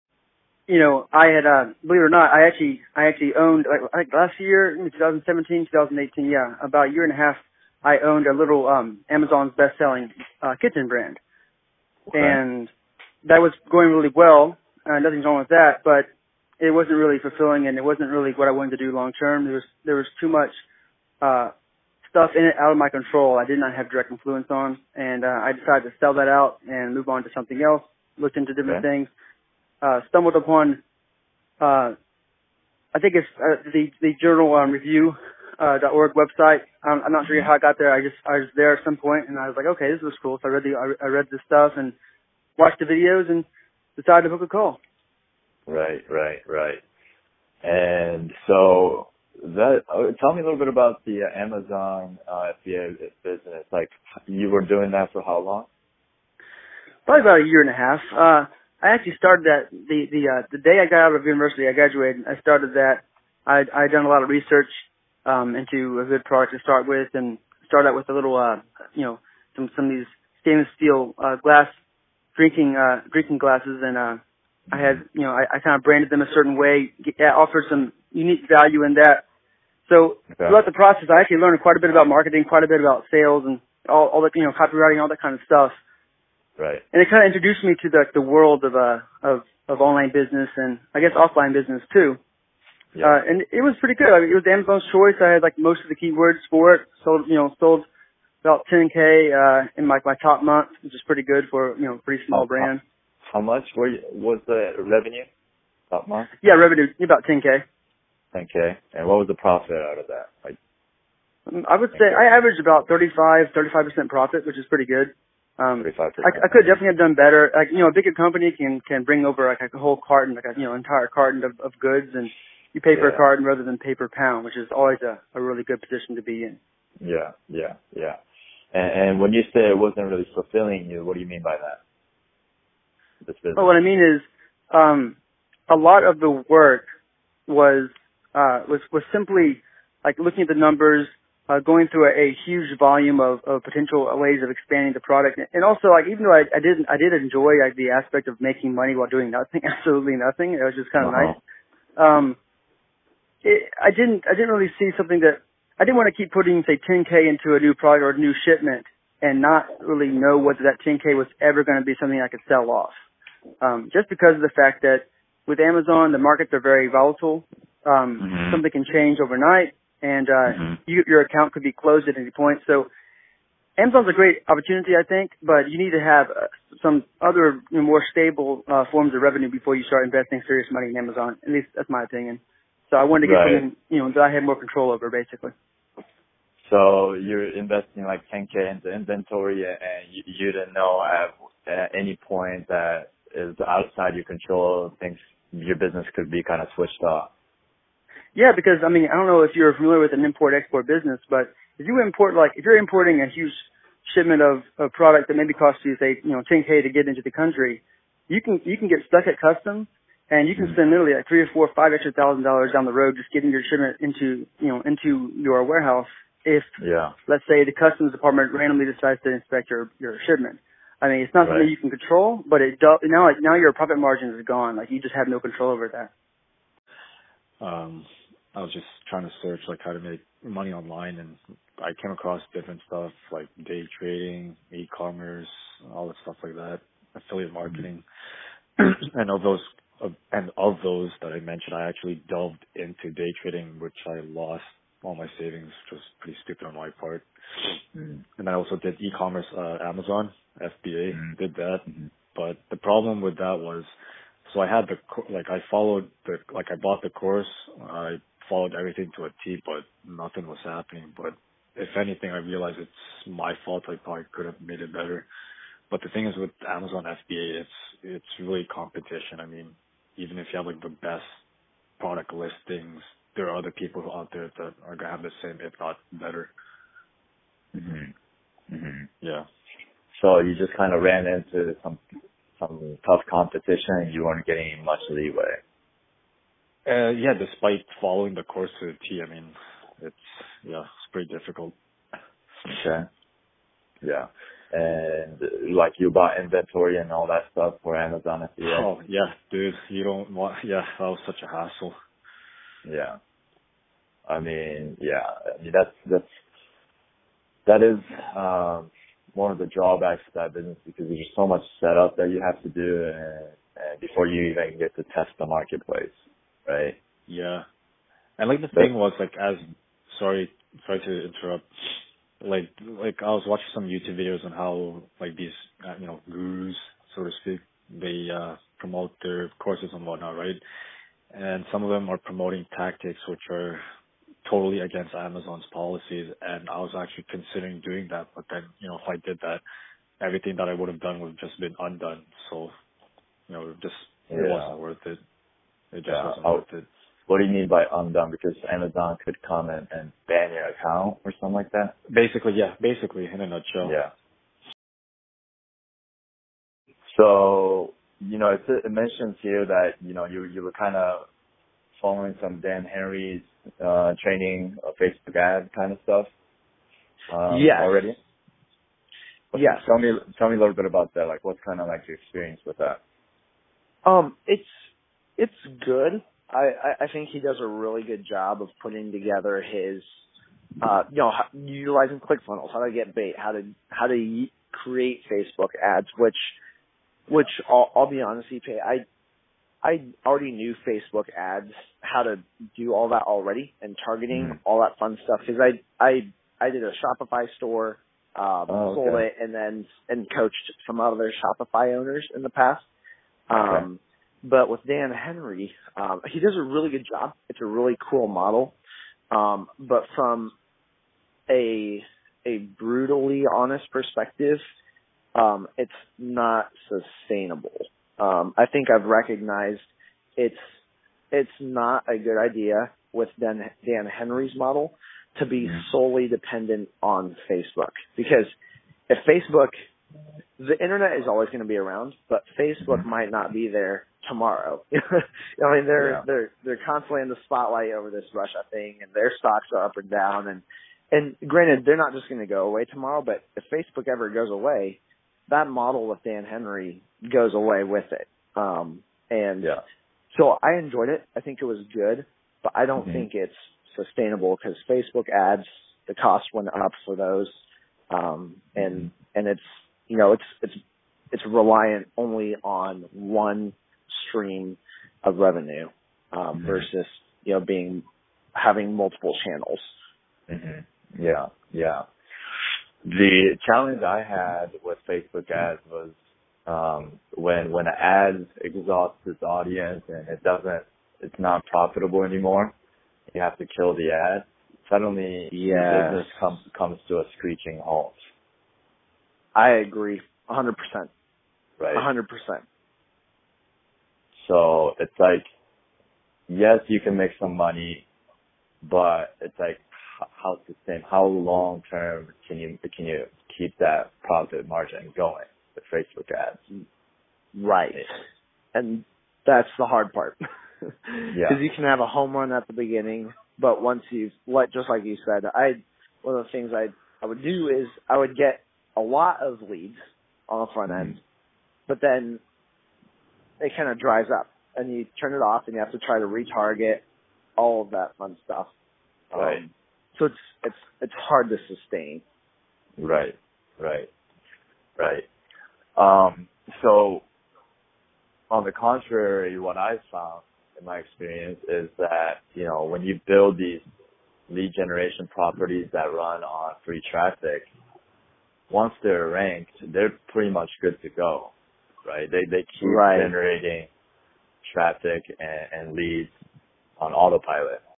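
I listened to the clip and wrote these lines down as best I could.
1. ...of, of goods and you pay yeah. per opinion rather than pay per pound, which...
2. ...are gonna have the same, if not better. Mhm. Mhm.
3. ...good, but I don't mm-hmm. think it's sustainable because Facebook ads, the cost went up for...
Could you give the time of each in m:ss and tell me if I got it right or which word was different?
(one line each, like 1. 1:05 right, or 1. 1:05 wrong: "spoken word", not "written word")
1. 2:01 wrong: "carton", not "opinion"
2. 4:34 right
3. 7:31 right.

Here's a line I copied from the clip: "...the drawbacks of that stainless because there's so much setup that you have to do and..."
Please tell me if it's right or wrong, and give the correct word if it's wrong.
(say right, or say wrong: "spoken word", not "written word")
wrong: "business", not "stainless".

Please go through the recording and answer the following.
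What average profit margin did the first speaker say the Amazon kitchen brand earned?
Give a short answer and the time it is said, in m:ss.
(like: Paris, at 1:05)
35%, at 1:53.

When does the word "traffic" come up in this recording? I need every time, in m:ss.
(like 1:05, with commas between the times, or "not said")
9:07, 9:14.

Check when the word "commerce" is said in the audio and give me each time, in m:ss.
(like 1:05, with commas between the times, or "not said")
3:54, 4:08.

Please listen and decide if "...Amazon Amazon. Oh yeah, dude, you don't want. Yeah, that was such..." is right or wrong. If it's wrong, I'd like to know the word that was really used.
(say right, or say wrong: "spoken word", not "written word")
wrong: "FBA", not "Amazon".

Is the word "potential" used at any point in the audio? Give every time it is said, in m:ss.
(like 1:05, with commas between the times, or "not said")
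2:23.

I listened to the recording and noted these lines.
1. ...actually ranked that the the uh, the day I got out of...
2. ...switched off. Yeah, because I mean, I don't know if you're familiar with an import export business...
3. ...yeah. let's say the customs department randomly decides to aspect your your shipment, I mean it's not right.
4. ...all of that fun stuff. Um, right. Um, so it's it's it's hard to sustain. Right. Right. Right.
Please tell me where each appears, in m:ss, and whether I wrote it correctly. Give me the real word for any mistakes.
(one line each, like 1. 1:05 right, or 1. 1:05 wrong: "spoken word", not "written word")
1. 0:58 wrong: "started", not "ranked"
2. 3:16 right
3. 3:36 wrong: "inspect", not "aspect"
4. 8:47 right.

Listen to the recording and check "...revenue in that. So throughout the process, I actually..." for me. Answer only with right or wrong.
wrong.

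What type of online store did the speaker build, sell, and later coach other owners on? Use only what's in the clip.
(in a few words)
Shopify store.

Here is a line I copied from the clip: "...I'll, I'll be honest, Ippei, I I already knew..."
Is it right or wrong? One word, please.
right.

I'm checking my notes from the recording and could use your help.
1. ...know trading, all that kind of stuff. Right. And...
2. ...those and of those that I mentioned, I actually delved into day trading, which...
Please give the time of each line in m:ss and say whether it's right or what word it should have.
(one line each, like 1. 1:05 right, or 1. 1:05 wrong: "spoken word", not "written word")
1. 1:24 wrong: "copywriting", not "trading"
2. 3:59 right.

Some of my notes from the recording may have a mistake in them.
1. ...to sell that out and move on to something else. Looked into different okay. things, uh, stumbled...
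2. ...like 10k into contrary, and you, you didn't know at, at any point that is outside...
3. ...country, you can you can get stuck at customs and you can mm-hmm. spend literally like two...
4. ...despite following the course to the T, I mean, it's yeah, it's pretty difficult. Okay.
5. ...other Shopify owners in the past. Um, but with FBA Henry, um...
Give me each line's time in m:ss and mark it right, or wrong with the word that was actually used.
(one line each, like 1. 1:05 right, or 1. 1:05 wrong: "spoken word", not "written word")
1. 0:25 right
2. 3:08 wrong: "inventory", not "contrary"
3. 3:27 wrong: "three", not "two"
4. 4:47 right
5. 6:41 wrong: "Dan", not "FBA".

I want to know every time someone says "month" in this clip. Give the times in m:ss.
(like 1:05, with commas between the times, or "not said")
1:40, 1:46.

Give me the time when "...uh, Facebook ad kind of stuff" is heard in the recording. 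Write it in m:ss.
6:04.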